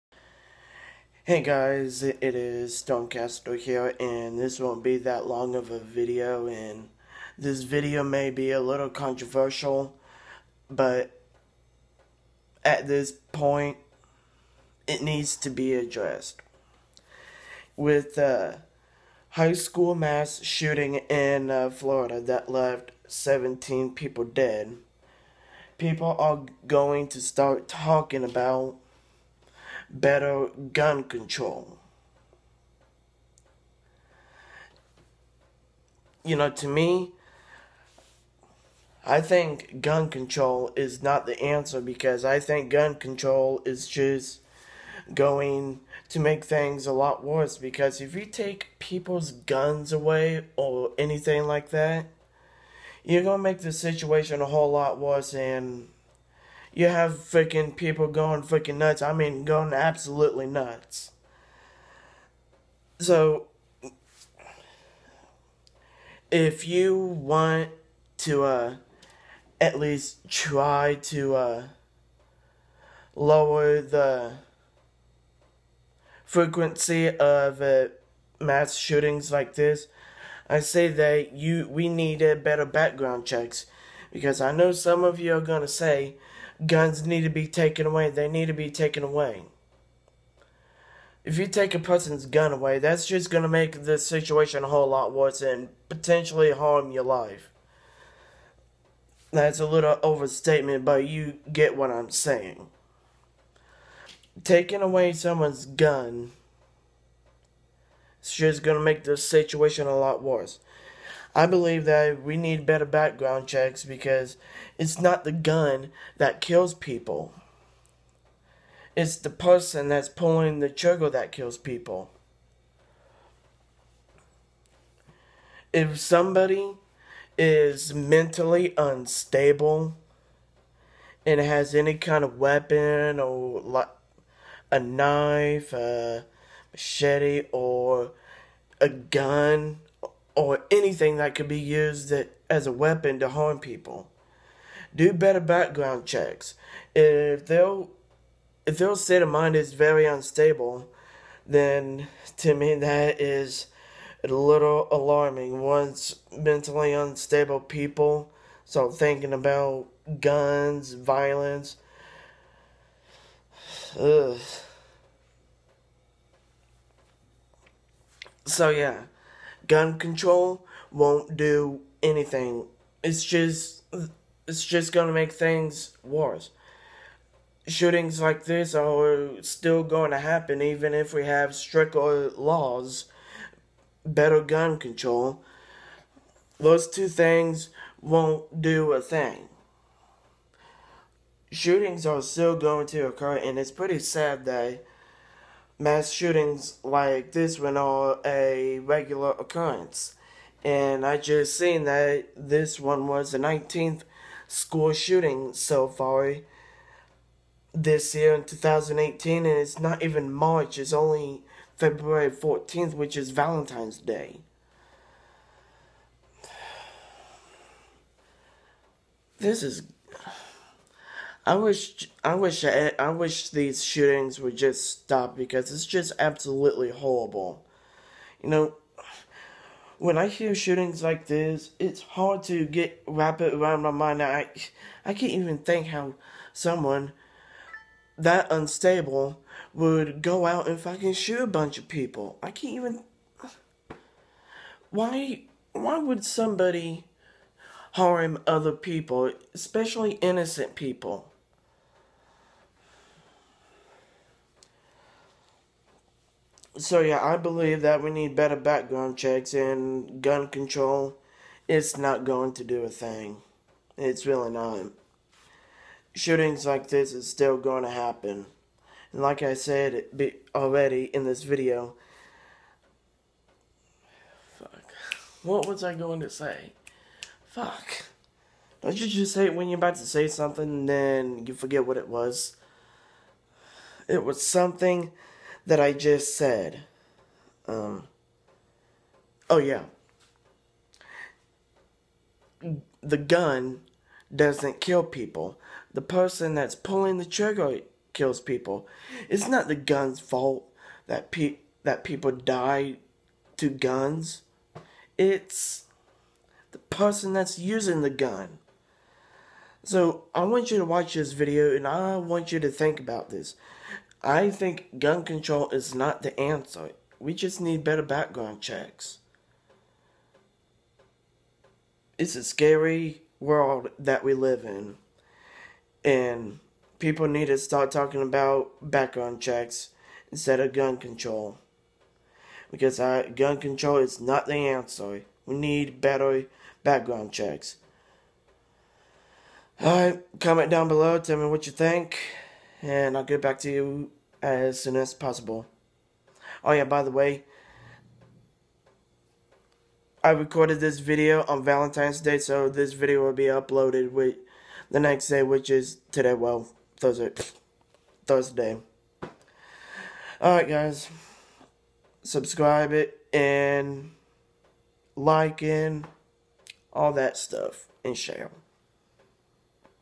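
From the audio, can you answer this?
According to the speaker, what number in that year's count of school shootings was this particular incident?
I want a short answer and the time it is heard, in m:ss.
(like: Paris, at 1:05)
19th, at 3:23.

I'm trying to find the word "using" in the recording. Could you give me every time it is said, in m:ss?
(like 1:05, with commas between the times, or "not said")
5:07.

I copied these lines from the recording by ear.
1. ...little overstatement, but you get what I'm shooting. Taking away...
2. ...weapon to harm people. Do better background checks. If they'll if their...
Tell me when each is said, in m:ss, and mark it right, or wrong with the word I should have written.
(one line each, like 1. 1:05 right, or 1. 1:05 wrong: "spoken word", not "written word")
1. 1:39 wrong: "saying", not "shooting"
2. 2:22 right.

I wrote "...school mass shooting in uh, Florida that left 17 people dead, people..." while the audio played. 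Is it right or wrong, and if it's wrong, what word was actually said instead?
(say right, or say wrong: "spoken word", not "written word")
right.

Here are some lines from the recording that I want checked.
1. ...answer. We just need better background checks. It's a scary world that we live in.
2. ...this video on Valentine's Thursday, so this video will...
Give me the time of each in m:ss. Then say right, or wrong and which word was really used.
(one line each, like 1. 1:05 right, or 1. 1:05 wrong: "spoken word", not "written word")
1. 5:16 right
2. 5:50 wrong: "Day", not "Thursday".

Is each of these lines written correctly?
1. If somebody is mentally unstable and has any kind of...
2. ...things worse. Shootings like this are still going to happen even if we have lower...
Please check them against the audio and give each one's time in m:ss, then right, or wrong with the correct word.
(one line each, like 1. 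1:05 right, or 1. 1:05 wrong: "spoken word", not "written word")
1. 2:05 right
2. 2:55 wrong: "stricter", not "lower".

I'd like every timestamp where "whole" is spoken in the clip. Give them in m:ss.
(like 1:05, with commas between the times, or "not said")
0:54, 1:34.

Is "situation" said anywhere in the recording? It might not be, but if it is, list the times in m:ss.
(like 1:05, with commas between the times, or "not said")
0:53, 1:33, 1:49.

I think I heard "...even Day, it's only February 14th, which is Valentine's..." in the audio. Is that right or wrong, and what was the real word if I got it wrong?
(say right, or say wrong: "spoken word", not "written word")
wrong: "March", not "Day".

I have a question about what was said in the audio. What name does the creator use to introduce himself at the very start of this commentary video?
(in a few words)
Stonecastle.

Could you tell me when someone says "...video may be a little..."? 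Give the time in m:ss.
0:07.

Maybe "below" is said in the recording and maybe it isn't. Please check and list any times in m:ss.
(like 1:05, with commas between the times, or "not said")
5:40.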